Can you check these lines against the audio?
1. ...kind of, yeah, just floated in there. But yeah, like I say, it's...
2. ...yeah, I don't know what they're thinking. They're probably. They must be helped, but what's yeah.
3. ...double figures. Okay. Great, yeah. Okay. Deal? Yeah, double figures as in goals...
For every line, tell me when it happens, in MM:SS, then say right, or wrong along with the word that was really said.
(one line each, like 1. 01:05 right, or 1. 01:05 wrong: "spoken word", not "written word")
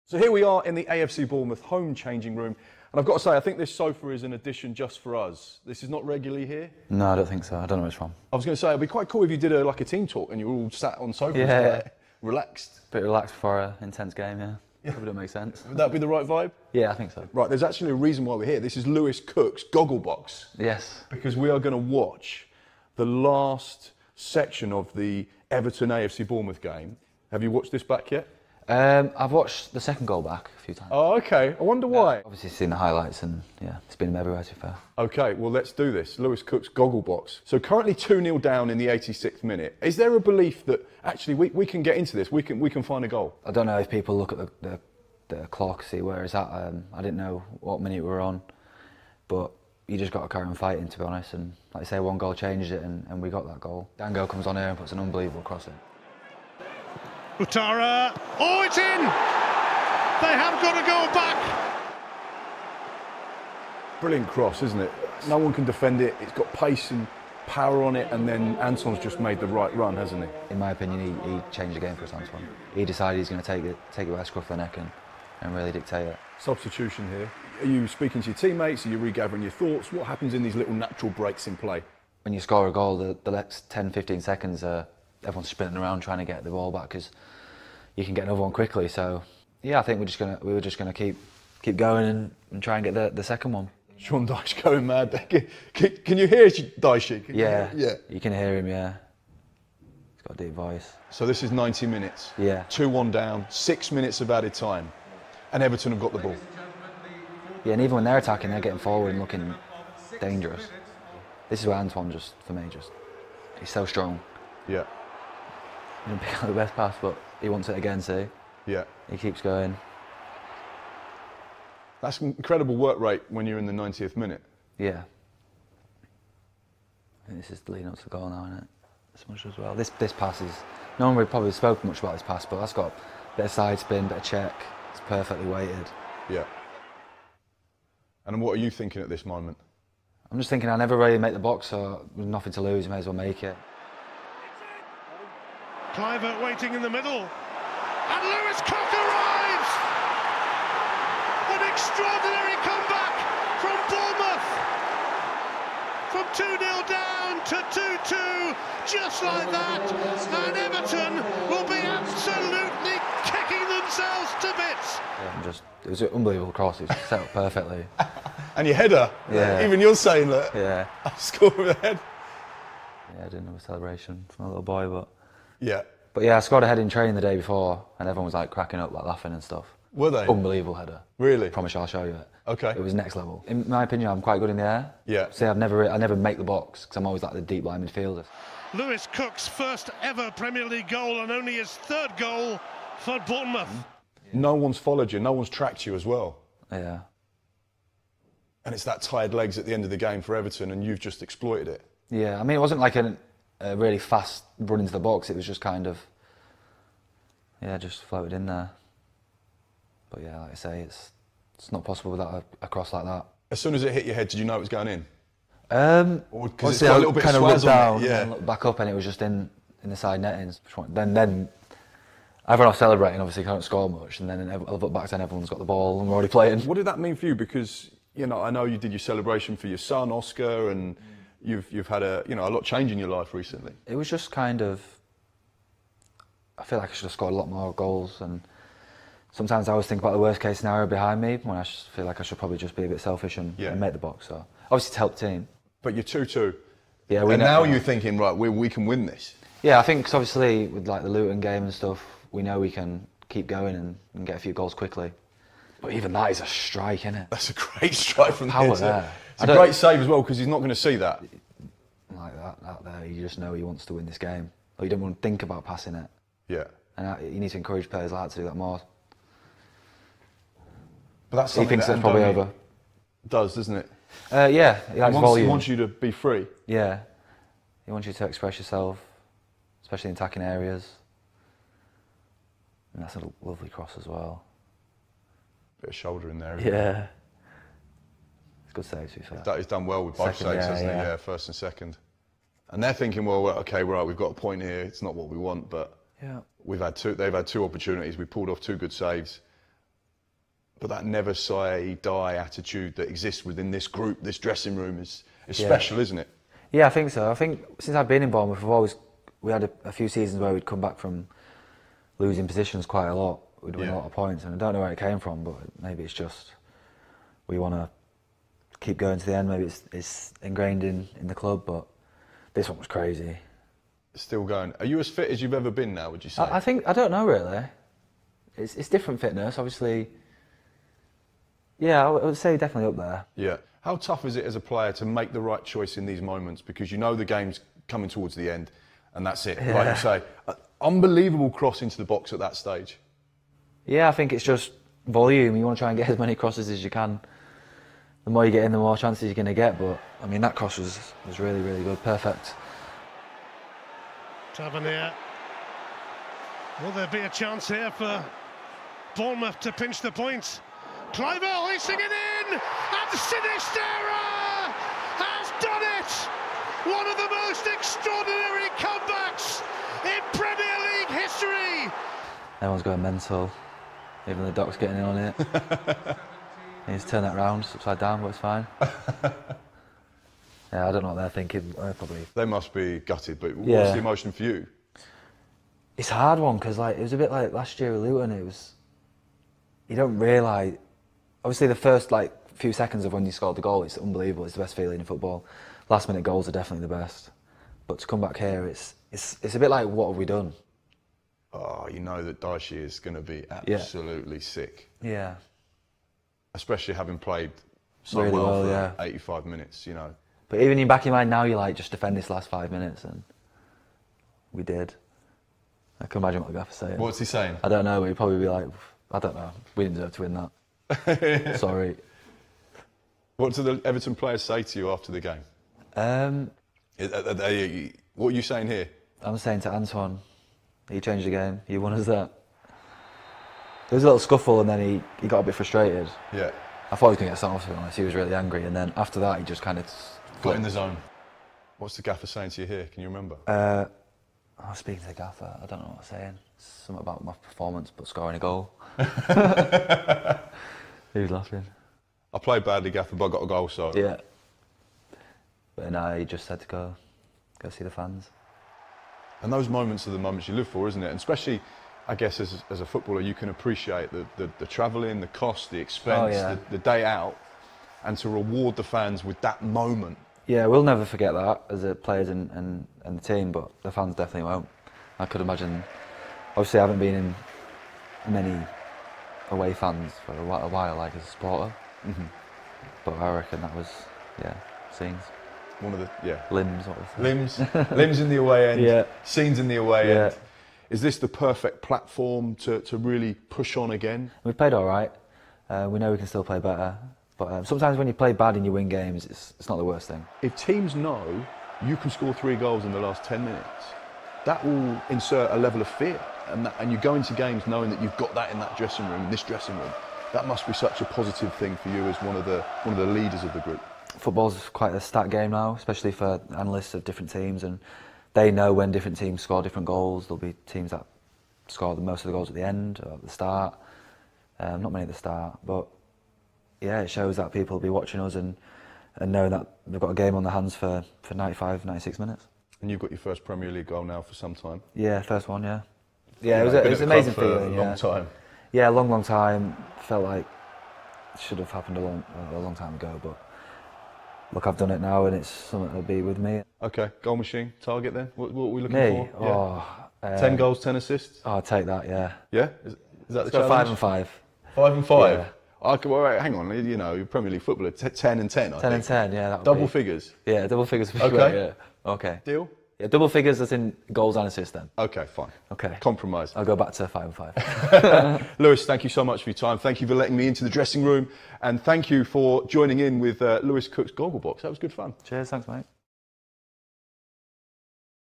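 1. 03:25 right
2. 06:20 wrong: "gutted", not "helped"
3. 09:20 right.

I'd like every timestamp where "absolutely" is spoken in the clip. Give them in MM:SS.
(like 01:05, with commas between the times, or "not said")
02:41, 06:43.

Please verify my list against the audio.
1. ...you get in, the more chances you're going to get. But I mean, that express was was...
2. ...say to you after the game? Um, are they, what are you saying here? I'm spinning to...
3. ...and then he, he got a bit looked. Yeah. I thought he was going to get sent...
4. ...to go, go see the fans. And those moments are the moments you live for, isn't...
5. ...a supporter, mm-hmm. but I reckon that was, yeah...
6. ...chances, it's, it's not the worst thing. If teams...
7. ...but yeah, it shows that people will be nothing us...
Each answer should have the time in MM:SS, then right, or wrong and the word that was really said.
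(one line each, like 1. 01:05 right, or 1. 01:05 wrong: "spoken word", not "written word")
1. 05:48 wrong: "cross", not "express"
2. 07:04 wrong: "saying", not "spinning"
3. 07:14 wrong: "frustrated", not "looked"
4. 07:36 right
5. 08:01 right
6. 08:18 wrong: "games", not "chances"
7. 08:45 wrong: "watching", not "nothing".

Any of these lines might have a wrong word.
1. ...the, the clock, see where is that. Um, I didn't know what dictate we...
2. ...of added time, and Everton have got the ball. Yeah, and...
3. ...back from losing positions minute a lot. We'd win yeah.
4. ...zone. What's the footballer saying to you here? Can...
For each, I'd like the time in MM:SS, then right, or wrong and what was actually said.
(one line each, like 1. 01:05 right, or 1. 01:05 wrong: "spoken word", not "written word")
1. 00:44 wrong: "minute", not "dictate"
2. 01:44 right
3. 05:10 wrong: "quite", not "minute"
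4. 07:20 wrong: "gaffer", not "footballer".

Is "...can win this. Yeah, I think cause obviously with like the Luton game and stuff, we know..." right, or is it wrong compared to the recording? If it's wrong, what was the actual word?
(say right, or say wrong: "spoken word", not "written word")
right.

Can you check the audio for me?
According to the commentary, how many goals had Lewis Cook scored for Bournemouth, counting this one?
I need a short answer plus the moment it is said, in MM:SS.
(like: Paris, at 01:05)
3rd, at 03:11.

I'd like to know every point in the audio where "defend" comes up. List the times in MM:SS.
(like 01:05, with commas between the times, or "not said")
01:05, 06:51.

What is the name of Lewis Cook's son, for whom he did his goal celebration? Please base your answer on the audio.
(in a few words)
Oscar.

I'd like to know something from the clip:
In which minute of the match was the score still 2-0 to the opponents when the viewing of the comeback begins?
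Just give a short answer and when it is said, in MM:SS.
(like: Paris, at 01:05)
86th, at 00:38.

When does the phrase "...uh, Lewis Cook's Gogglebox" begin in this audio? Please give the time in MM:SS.
09:33.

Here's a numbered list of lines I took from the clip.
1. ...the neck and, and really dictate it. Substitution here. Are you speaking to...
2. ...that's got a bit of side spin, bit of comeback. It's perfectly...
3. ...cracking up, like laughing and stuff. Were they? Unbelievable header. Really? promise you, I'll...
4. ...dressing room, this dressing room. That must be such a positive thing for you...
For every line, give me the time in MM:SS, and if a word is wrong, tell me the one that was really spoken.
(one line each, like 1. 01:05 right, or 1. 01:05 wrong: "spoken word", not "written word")
1. 01:14 right
2. 02:12 wrong: "check", not "comeback"
3. 02:58 right
4. 08:28 right.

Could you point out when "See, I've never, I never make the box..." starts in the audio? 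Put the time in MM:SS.
03:05.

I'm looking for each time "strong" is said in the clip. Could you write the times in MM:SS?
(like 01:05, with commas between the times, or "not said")
01:53.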